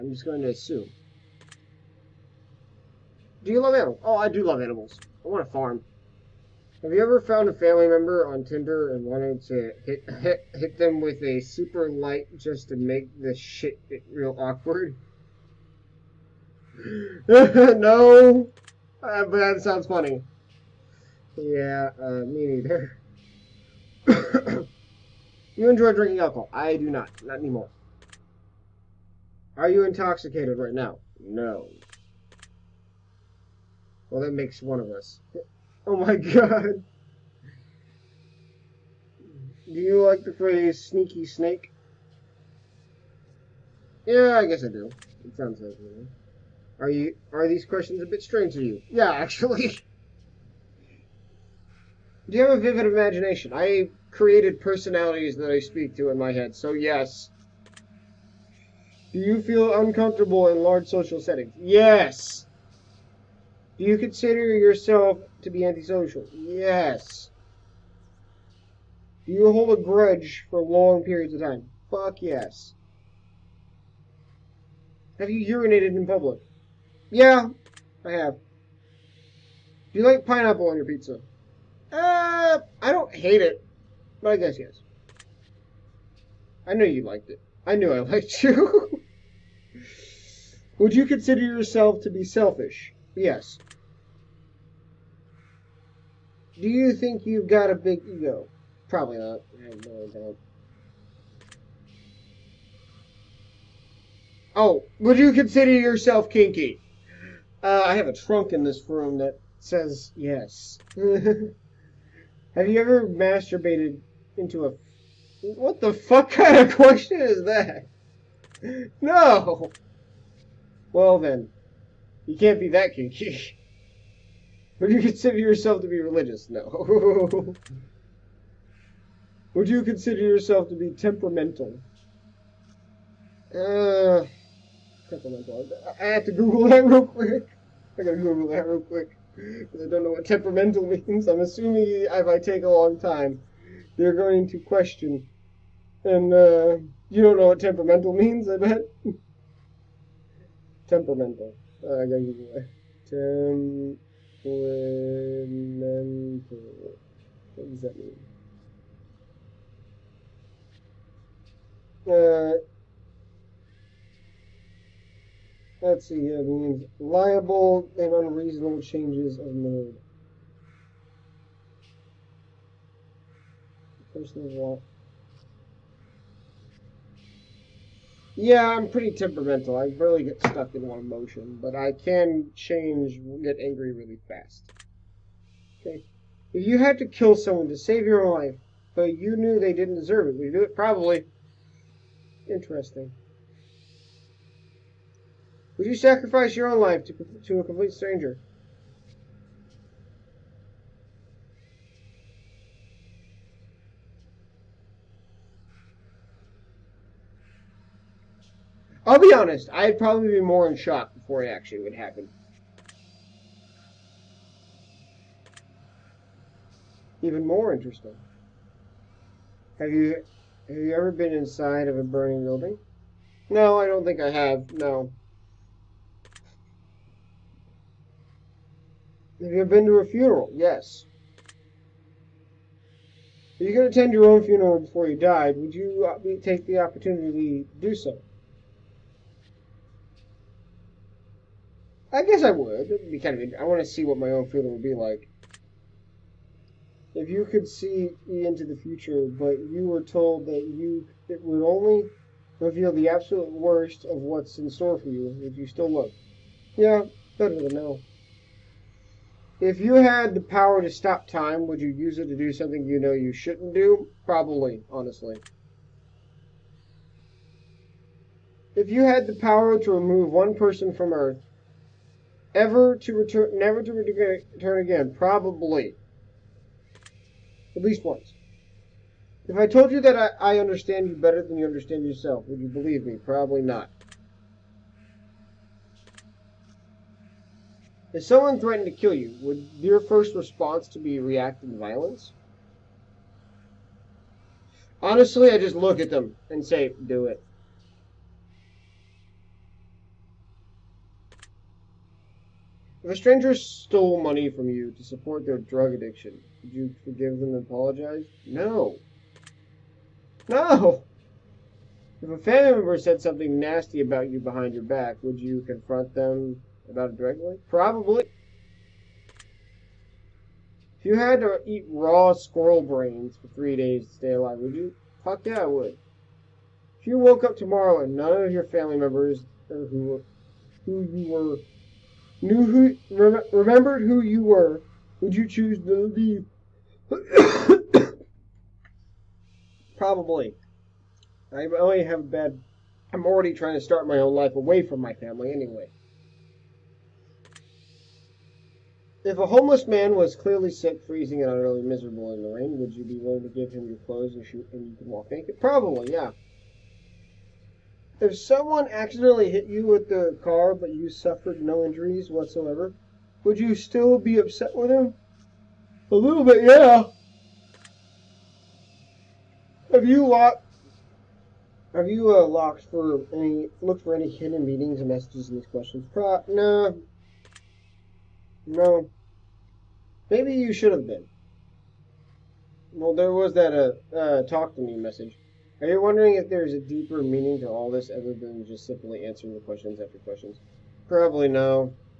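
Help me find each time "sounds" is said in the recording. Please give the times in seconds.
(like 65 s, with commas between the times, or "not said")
19 s, 45 s.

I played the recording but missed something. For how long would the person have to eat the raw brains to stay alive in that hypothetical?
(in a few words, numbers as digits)
3 days.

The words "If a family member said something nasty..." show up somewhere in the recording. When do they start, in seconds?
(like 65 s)
312 s.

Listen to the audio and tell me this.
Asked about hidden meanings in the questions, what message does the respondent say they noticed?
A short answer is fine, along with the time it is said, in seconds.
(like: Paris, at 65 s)
Talk to me, at 384 s.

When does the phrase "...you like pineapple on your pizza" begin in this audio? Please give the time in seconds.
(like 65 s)
79 s.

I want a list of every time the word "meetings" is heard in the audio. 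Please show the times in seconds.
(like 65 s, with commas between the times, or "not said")
374 s.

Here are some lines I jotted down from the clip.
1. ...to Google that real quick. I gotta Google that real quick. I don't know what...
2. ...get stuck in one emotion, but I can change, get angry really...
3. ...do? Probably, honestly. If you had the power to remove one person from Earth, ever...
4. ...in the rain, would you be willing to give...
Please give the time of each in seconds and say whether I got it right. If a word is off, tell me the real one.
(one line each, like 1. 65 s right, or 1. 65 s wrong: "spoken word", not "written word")
1. 136 s right
2. 180 s right
3. 263 s right
4. 352 s right.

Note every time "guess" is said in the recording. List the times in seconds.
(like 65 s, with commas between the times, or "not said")
44 s, 84 s, 242 s.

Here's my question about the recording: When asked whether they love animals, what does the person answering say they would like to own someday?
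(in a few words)
A farm.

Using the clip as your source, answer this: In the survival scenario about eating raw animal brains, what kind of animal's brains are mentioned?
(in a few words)
Squirrel.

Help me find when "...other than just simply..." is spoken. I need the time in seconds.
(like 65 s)
388 s.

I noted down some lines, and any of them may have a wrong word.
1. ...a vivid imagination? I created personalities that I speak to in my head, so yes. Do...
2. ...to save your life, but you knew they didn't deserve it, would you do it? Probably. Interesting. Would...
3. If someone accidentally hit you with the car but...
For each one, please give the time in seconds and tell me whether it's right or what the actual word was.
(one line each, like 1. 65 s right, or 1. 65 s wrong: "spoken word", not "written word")
1. 52 s right
2. 187 s right
3. 358 s right.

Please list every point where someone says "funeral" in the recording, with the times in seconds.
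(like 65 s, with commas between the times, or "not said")
230 s, 234 s, 244 s.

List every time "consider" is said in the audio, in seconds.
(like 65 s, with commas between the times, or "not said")
63 s, 91 s, 105 s, 125 s, 129 s.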